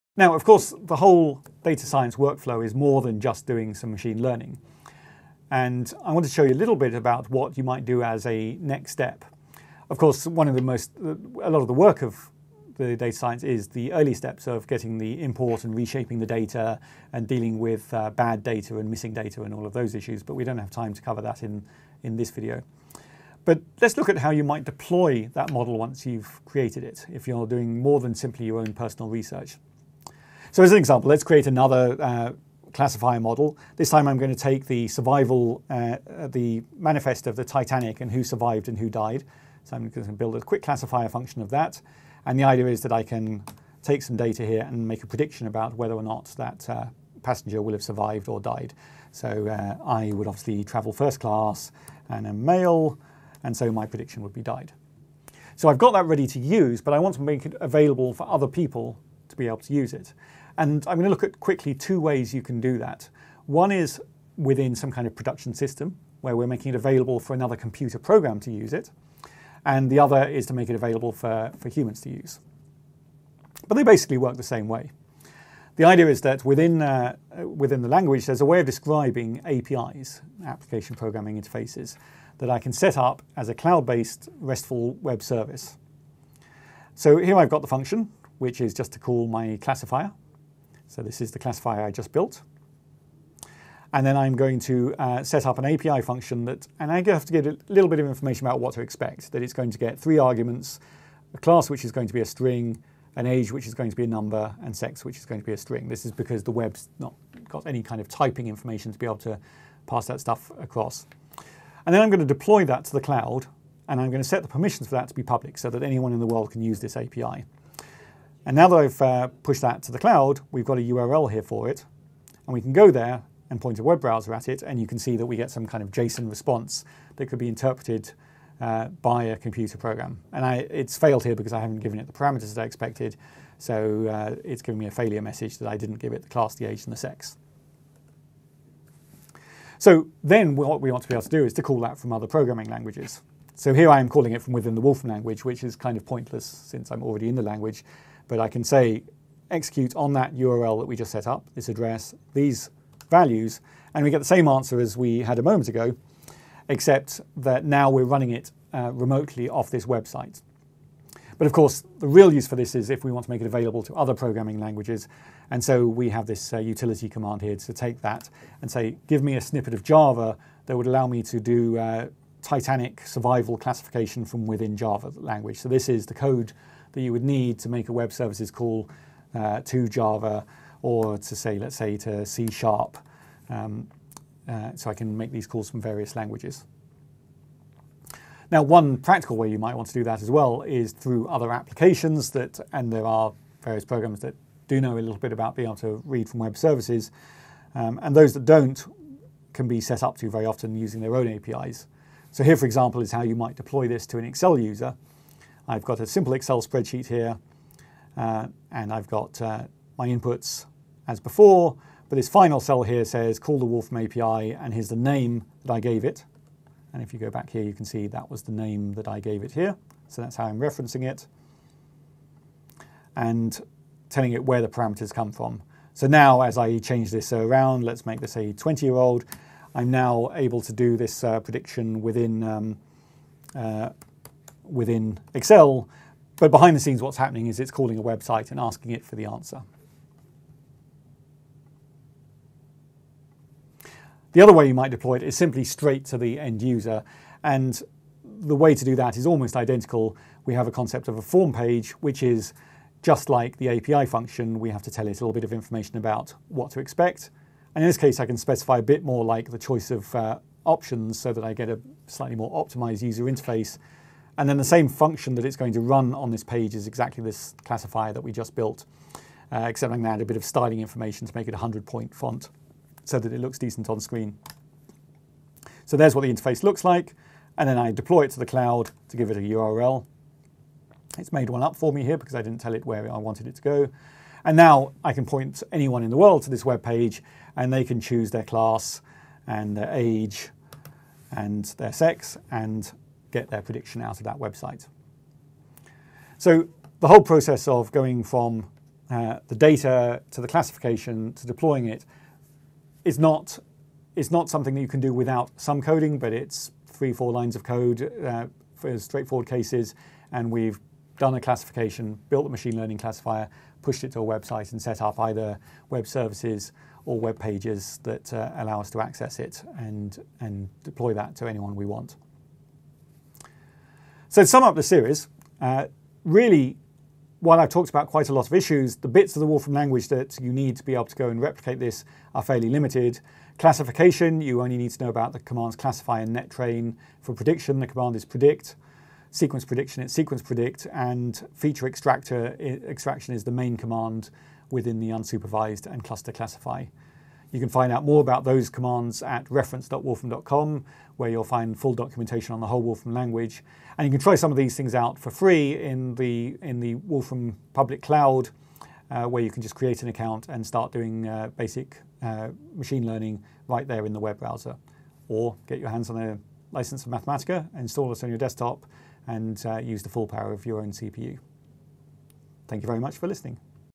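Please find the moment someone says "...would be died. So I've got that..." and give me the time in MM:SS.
00:54.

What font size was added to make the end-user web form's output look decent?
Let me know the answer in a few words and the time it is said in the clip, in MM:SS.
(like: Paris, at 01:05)
100-point, at 04:31.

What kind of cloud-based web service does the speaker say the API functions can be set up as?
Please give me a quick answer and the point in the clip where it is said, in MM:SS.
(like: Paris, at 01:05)
RESTful web service, at 01:24.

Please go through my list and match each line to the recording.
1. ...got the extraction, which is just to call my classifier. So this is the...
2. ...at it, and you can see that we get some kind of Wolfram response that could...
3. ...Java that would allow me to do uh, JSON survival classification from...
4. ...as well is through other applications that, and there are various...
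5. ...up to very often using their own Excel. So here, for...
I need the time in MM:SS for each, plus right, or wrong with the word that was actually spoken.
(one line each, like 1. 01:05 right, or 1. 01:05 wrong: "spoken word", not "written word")
1. 01:27 wrong: "function", not "extraction"
2. 02:04 wrong: "JSON", not "Wolfram"
3. 02:49 wrong: "Titanic", not "JSON"
4. 03:10 right
5. 03:20 wrong: "APIs", not "Excel".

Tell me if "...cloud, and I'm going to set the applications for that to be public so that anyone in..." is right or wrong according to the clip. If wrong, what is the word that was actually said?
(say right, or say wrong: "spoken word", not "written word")
wrong: "permissions", not "applications".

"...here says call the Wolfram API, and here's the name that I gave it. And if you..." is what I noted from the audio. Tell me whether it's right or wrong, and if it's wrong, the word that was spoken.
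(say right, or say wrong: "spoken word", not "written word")
right.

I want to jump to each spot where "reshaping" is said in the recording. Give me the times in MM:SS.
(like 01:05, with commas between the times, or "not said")
00:15.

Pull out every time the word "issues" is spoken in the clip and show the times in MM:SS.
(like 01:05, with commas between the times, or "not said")
00:19, 05:28.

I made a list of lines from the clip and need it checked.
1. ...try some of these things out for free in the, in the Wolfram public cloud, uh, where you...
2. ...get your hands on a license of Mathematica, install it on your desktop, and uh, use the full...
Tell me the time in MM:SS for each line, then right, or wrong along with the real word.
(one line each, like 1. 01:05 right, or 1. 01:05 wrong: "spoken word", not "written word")
1. 05:54 right
2. 06:05 right.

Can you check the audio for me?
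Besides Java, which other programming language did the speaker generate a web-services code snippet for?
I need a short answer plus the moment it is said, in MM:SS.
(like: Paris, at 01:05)
C Sharp, at 03:02.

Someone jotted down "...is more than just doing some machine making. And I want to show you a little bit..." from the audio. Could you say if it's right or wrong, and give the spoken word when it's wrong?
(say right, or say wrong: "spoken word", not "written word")
wrong: "learning", not "making".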